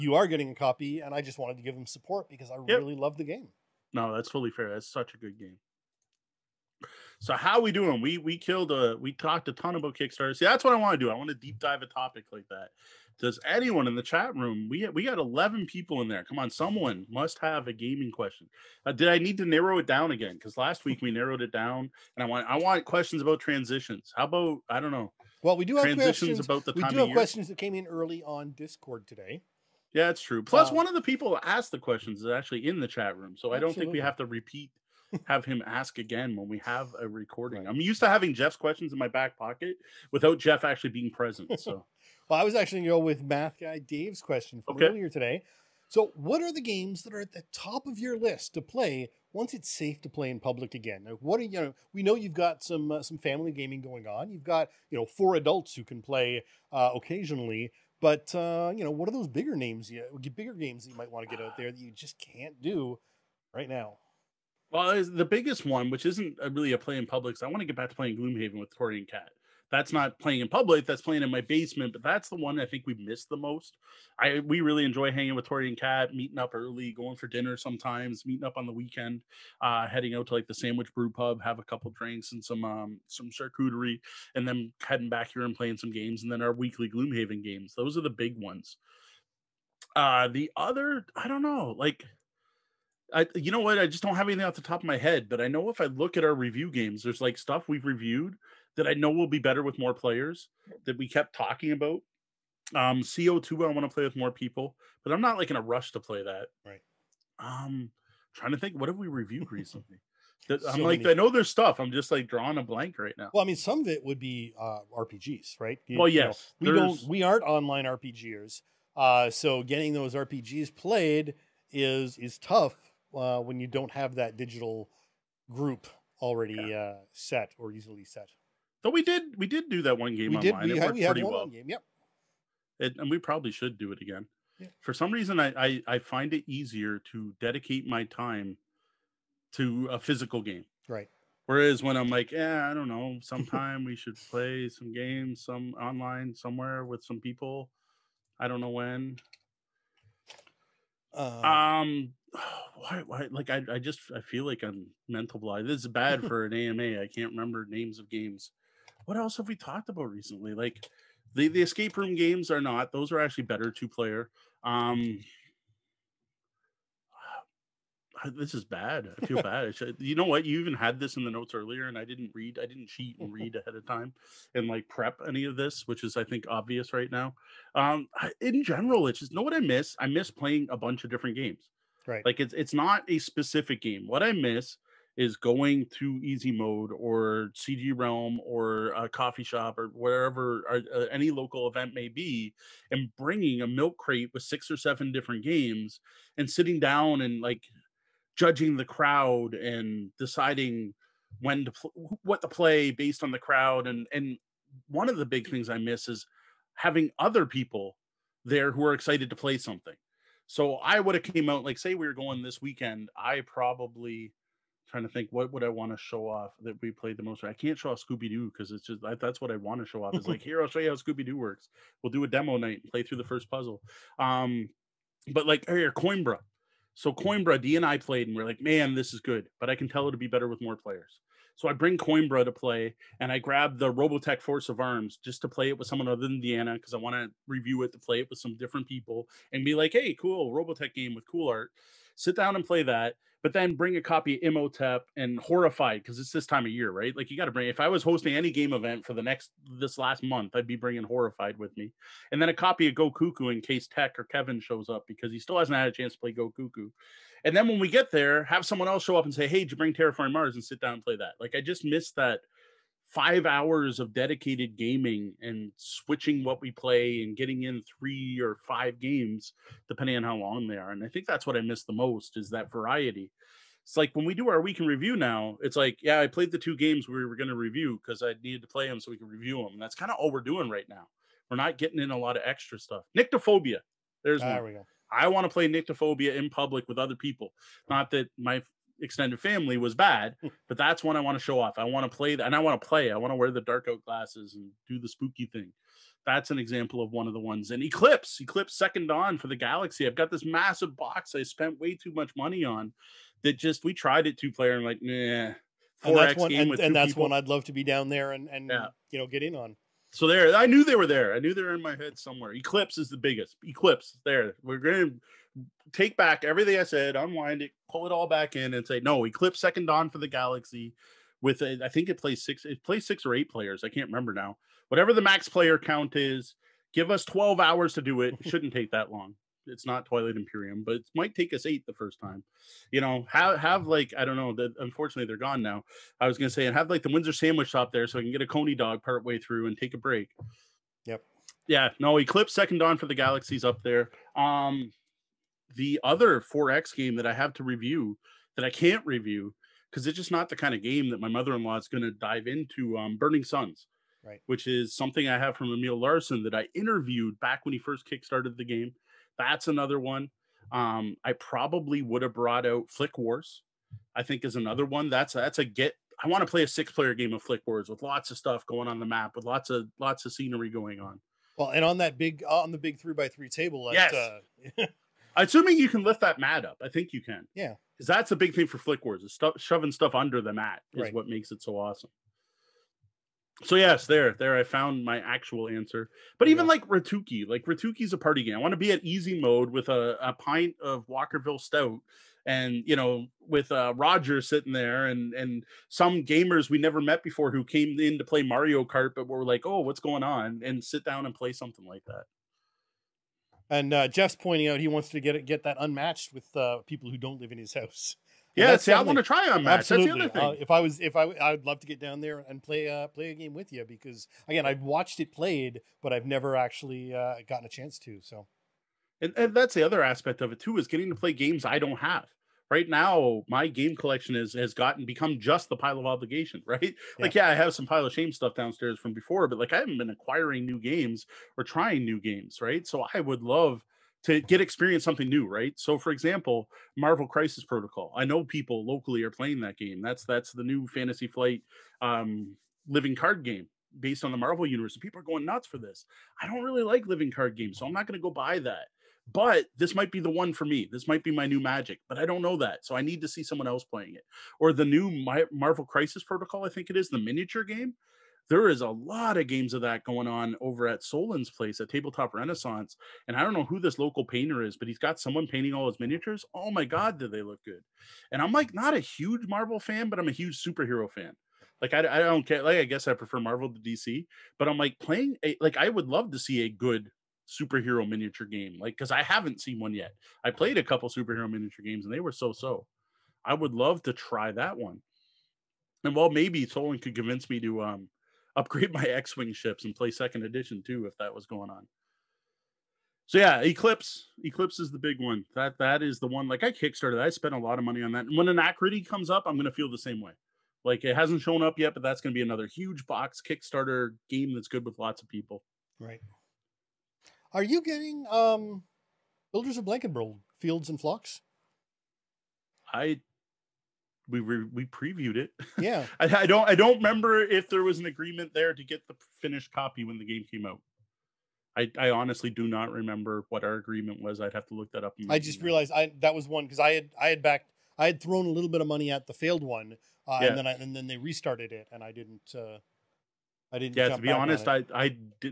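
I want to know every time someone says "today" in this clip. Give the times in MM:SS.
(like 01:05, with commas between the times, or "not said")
00:29, 00:45.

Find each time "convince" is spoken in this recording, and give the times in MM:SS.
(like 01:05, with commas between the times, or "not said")
08:07.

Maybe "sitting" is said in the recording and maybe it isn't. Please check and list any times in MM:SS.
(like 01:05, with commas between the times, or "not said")
03:16, 06:34.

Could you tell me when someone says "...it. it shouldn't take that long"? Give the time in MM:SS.
05:28.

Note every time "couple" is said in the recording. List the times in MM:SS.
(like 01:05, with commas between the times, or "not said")
01:21, 08:00.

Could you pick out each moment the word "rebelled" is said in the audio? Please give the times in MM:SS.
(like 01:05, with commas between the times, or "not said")
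not said.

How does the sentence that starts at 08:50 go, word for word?
and then I, and then they restarted it, and I didn't.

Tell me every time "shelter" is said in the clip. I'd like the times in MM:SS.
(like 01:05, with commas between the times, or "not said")
not said.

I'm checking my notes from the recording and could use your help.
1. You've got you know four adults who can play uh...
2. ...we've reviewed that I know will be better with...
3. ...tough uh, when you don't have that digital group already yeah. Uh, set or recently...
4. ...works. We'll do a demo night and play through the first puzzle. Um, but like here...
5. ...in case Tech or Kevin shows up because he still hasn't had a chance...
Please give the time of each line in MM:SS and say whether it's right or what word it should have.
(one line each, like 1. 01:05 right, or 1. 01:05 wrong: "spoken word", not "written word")
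1. 00:54 right
2. 01:37 right
3. 02:02 wrong: "easily", not "recently"
4. 03:41 right
5. 04:13 right.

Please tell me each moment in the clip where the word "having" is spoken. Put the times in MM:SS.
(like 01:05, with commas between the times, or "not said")
00:38, 03:26.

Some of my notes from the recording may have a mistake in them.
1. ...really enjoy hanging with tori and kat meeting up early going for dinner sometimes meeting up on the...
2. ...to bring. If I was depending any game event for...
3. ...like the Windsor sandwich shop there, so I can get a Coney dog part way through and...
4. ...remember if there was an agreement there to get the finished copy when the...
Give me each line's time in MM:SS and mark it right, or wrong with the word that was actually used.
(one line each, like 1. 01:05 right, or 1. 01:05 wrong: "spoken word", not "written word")
1. 01:14 right
2. 04:07 wrong: "hosting", not "depending"
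3. 05:36 right
4. 08:36 right.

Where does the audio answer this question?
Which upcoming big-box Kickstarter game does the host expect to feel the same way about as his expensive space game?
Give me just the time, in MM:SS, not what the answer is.
08:18.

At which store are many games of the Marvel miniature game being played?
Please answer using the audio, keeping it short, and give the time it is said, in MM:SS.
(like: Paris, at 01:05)
Tabletop Renaissance, at 07:41.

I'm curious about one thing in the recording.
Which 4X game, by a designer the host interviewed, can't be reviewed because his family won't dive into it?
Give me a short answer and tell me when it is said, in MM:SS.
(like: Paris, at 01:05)
Burning Suns, at 05:53.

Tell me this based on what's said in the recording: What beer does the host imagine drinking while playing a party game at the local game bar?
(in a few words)
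Walkerville Stout.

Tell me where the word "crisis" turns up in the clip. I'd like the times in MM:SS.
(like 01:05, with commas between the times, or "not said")
07:17, 07:35.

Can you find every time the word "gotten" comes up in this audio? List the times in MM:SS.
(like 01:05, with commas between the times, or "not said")
06:57, 07:04.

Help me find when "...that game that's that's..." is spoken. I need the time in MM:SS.
07:19.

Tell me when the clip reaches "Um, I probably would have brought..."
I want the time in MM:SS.
06:00.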